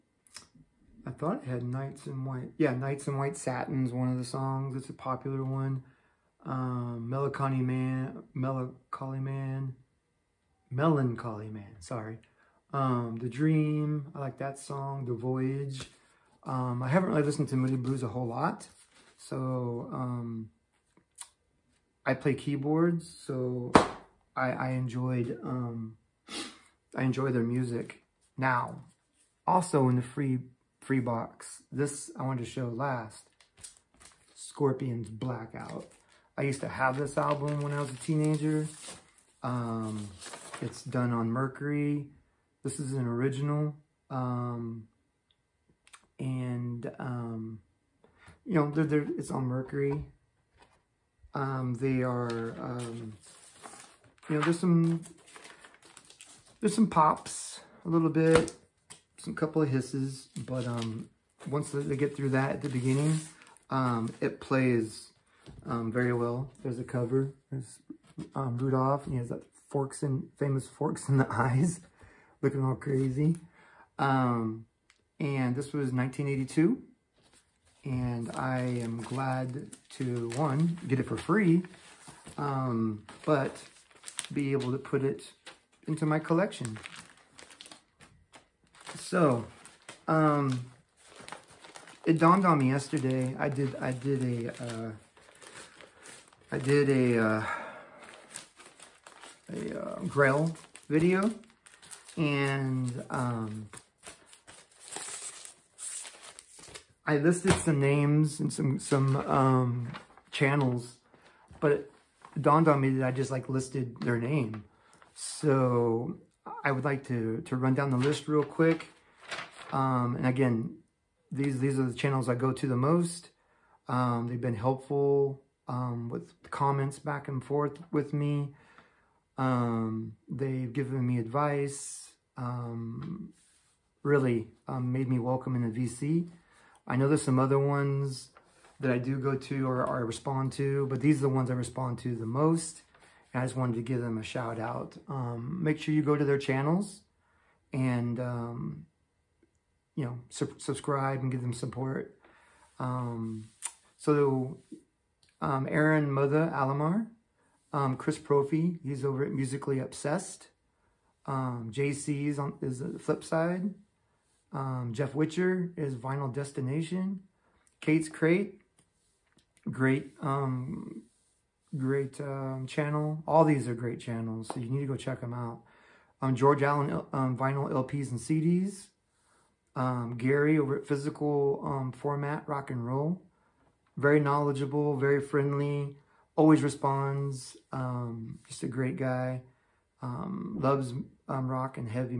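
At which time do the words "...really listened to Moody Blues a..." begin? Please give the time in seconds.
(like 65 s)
17 s.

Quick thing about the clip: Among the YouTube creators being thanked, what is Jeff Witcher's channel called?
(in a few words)
Vinyl Destination.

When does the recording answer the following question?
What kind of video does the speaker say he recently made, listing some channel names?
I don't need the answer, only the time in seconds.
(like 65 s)
99 s.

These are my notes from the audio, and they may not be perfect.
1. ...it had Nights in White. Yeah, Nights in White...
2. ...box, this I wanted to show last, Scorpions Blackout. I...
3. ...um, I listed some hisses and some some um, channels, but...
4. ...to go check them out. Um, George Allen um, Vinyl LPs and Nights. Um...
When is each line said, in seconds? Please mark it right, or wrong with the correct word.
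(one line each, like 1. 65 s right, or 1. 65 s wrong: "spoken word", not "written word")
1. 1 s right
2. 30 s right
3. 103 s wrong: "names", not "hisses"
4. 174 s wrong: "CDs", not "Nights".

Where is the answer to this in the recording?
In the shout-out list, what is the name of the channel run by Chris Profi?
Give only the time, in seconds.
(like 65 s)
159 s.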